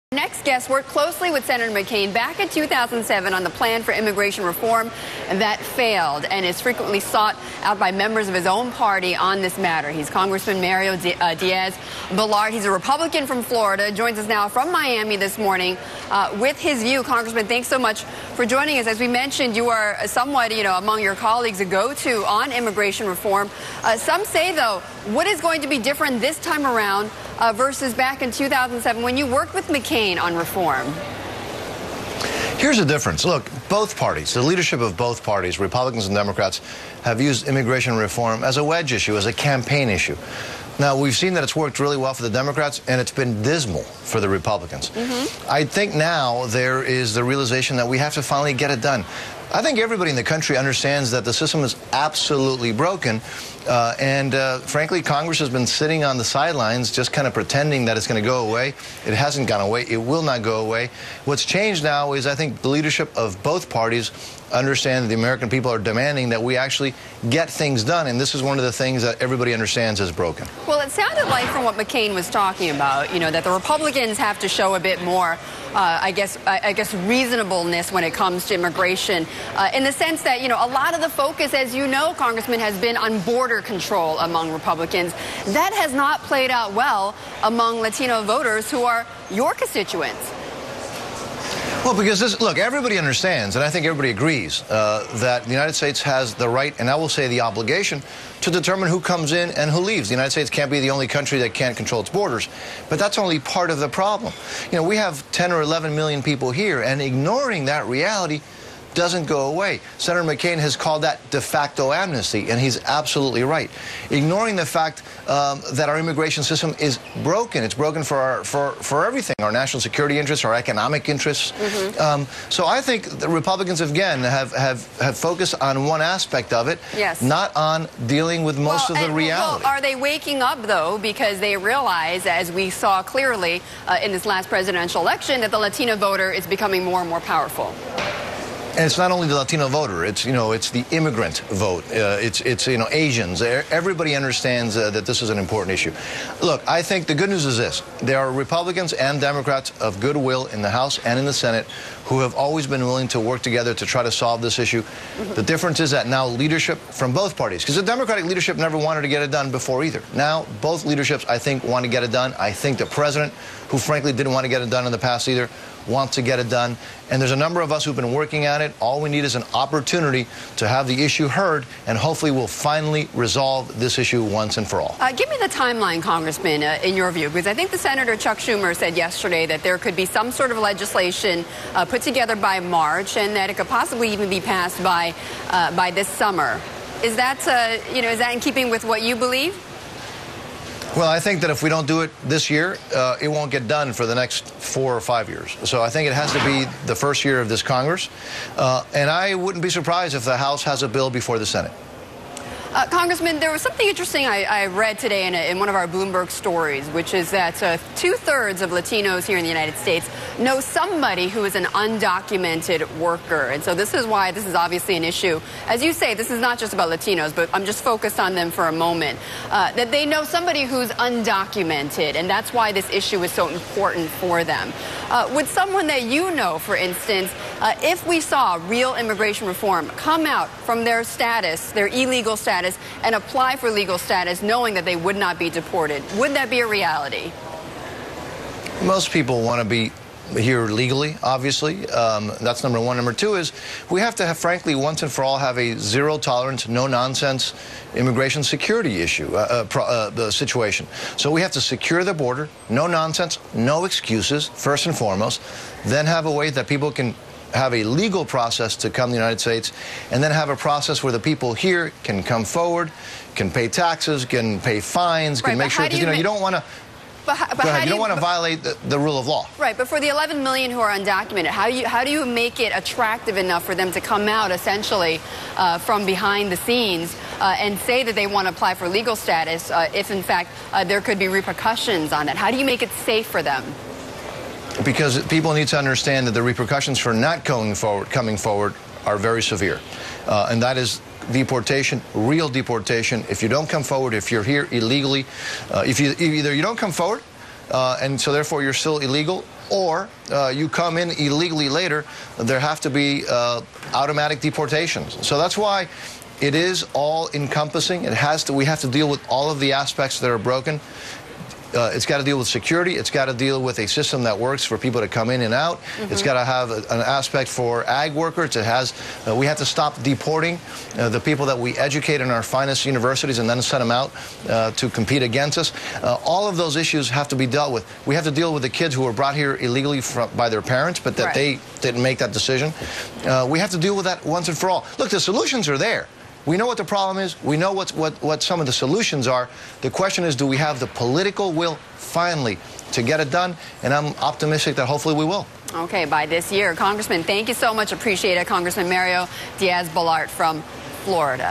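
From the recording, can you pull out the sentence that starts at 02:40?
Now both leaderships, I think, want to get it done.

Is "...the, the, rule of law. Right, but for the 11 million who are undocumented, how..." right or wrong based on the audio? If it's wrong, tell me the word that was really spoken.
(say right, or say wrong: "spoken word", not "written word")
right.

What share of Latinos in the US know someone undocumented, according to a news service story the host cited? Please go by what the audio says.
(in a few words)
two thirds.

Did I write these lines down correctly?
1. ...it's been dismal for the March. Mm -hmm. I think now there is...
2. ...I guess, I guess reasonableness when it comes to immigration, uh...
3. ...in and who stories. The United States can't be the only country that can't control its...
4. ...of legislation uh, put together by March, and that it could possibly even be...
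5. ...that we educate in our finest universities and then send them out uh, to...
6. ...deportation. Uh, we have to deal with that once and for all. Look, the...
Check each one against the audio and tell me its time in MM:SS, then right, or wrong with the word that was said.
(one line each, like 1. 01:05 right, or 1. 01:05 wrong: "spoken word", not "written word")
1. 00:43 wrong: "Republicans", not "March"
2. 01:16 right
3. 01:39 wrong: "leaves", not "stories"
4. 03:00 right
5. 05:21 right
6. 05:32 wrong: "decision", not "deportation".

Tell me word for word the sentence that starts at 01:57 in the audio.
It's broken for, our, for, for everything, our national security interests, our economic interests.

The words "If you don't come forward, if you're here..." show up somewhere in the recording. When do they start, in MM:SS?
04:53.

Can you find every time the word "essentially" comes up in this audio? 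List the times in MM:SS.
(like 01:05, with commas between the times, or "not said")
04:34.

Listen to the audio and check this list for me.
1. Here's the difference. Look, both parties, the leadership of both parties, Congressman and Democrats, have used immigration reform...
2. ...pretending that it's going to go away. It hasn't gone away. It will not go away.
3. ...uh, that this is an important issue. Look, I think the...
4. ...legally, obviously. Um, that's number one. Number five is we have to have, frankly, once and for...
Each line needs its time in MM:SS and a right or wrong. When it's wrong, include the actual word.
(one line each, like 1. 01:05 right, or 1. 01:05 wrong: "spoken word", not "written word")
1. 00:32 wrong: "Republicans", not "Congressman"
2. 00:57 right
3. 02:24 right
4. 04:00 wrong: "two", not "five".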